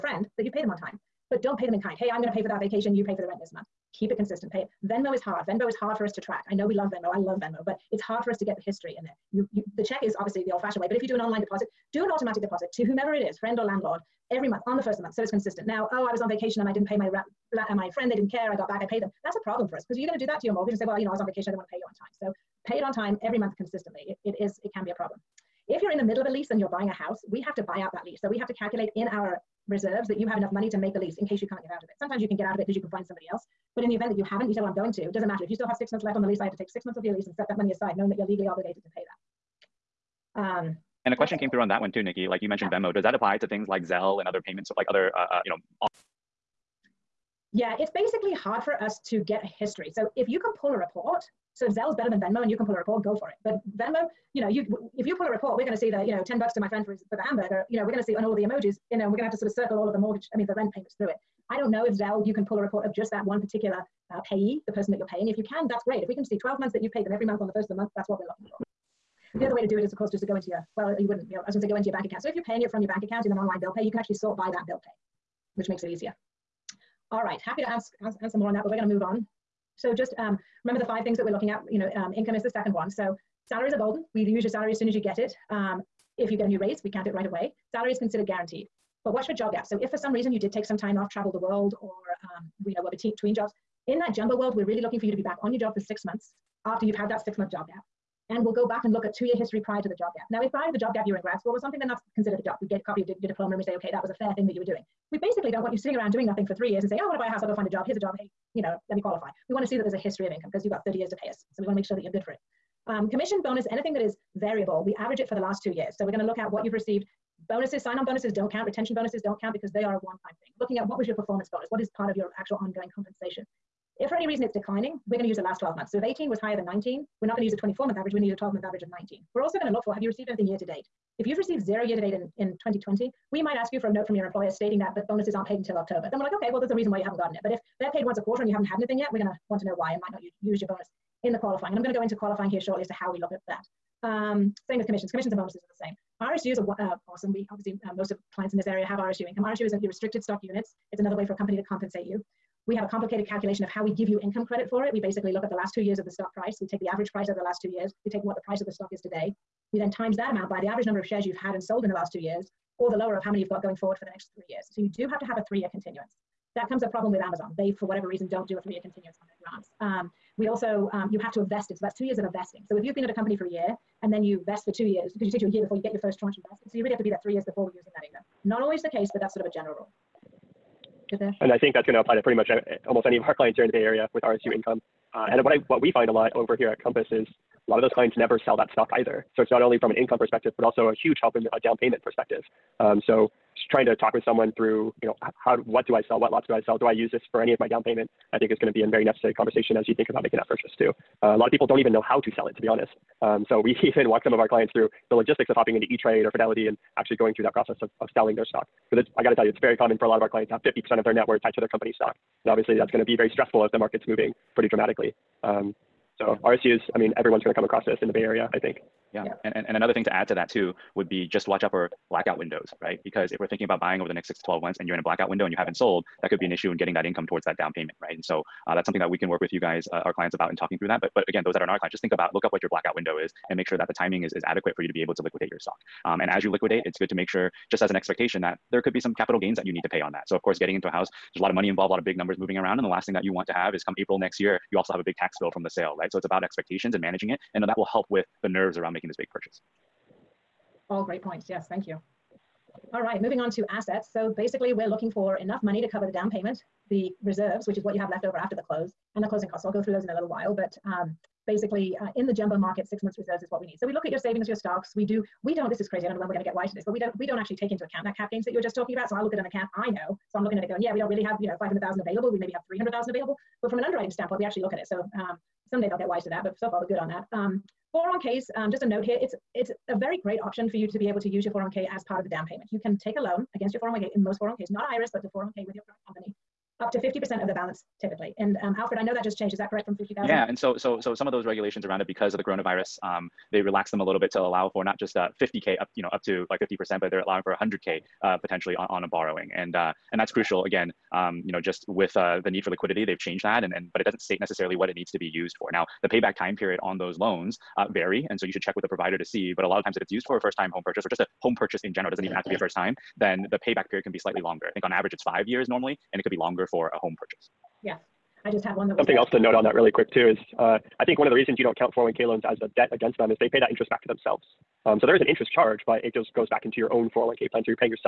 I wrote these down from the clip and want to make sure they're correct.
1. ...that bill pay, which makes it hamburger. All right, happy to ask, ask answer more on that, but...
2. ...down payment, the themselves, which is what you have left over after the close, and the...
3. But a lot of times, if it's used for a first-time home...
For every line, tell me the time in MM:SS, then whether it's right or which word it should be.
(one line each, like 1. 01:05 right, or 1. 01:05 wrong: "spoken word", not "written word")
1. 01:14 wrong: "easier", not "hamburger"
2. 04:16 wrong: "reserves", not "themselves"
3. 05:09 right.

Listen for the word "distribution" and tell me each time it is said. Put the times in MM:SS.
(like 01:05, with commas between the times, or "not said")
not said.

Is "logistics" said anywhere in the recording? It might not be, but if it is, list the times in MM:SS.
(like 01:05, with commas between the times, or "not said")
03:25.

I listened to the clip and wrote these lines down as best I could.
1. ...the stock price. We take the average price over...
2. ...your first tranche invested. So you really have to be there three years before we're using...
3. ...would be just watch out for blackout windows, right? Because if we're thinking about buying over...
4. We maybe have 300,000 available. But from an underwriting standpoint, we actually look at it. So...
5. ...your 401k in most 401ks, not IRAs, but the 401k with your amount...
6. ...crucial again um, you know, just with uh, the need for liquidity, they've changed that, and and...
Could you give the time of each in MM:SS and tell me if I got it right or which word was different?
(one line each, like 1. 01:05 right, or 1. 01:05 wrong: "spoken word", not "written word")
1. 02:36 right
2. 02:55 right
3. 03:40 right
4. 04:32 right
5. 04:43 wrong: "current", not "amount"
6. 05:00 right.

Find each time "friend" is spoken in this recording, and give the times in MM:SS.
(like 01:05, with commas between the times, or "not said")
00:13, 00:17, 00:56.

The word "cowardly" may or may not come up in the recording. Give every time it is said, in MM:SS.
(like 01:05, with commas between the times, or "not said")
not said.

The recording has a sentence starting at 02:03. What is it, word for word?
If for any reason it's declining, we're going to use the last 12 months.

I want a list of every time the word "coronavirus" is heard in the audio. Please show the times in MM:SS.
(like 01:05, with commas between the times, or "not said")
04:52.